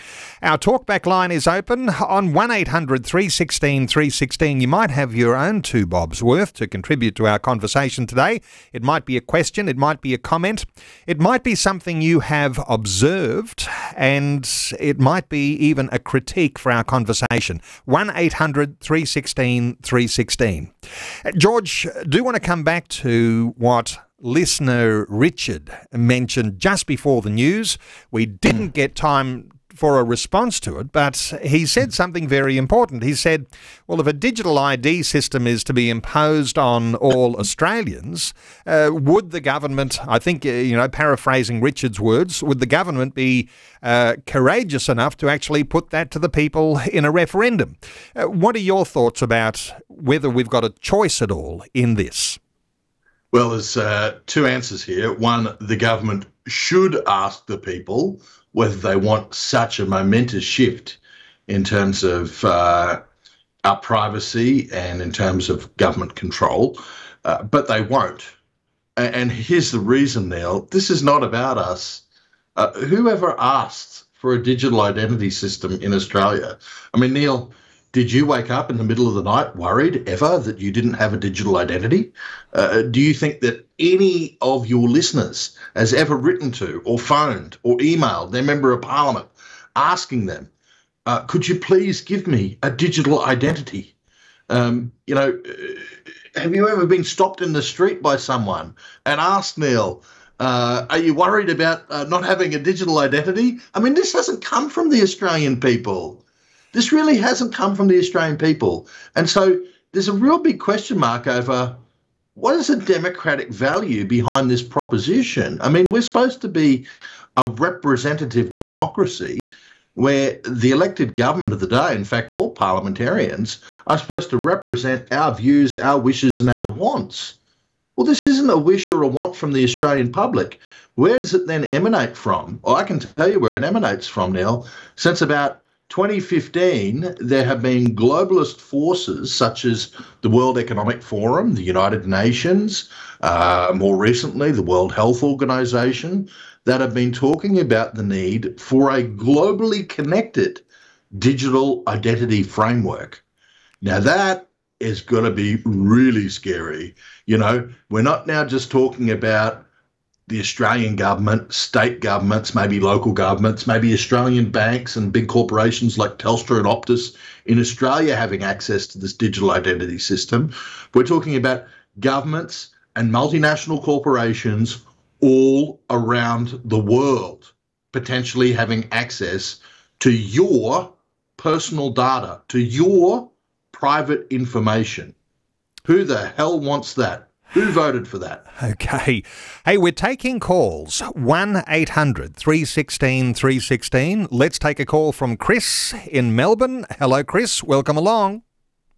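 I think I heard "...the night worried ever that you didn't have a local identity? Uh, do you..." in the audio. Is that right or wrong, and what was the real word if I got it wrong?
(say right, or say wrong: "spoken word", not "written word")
wrong: "digital", not "local".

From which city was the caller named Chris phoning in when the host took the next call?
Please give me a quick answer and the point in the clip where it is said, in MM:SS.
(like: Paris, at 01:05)
Melbourne, at 03:16.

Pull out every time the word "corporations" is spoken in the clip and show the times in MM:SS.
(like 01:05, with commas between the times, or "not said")
02:45, 02:53.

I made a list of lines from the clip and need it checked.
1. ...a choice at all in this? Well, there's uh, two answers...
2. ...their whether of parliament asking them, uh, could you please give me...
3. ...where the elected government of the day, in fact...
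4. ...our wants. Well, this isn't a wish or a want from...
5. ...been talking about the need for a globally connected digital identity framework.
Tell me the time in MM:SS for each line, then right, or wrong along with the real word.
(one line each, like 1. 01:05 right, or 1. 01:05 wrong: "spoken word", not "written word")
1. 00:50 right
2. 01:28 wrong: "member", not "whether"
3. 01:59 right
4. 02:06 right
5. 02:26 right.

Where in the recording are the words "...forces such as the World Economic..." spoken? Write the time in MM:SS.
02:18.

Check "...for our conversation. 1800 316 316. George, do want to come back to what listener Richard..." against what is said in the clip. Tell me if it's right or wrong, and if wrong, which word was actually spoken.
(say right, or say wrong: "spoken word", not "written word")
right.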